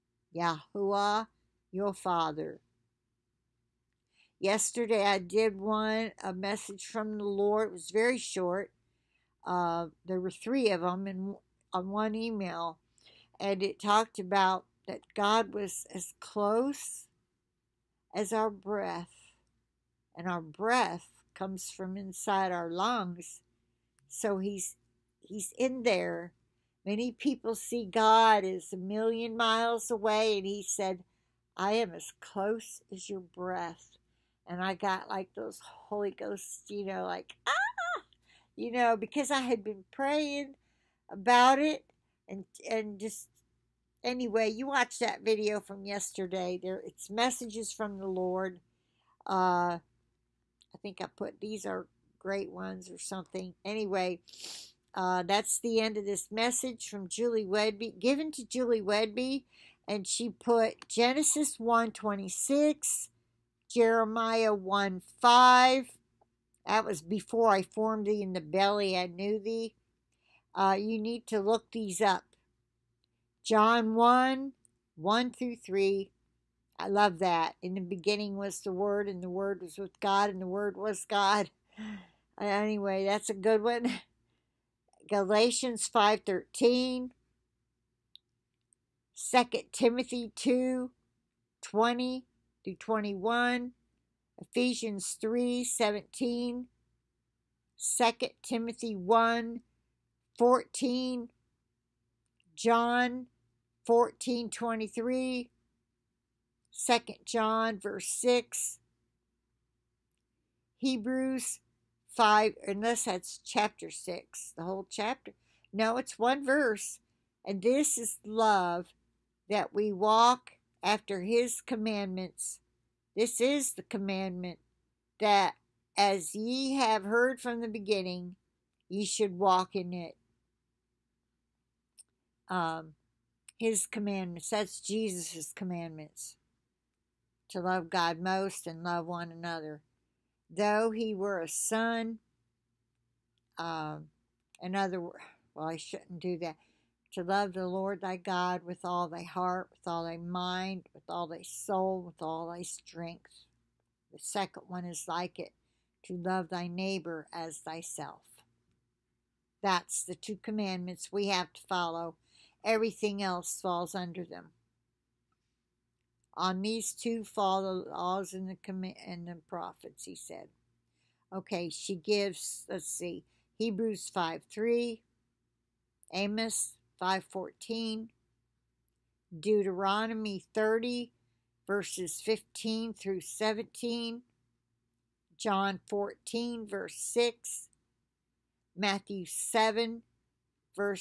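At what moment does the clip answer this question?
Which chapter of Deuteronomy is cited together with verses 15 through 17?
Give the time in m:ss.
3:00.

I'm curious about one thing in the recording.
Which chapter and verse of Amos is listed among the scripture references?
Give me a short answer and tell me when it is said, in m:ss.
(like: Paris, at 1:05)
Amos 5:14, at 2:56.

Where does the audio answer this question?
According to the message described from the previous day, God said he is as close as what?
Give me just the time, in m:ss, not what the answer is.
0:33.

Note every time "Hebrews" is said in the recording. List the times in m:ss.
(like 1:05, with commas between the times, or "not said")
1:50, 2:53.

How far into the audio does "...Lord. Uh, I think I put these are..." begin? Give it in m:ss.
0:48.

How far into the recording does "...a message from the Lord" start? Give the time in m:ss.
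0:06.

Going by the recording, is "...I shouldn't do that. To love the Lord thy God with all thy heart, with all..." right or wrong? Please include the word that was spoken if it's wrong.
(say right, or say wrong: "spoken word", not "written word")
right.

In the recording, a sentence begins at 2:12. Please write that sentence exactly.
Um, his commandments, that's Jesus' commandments to love God most and love one another.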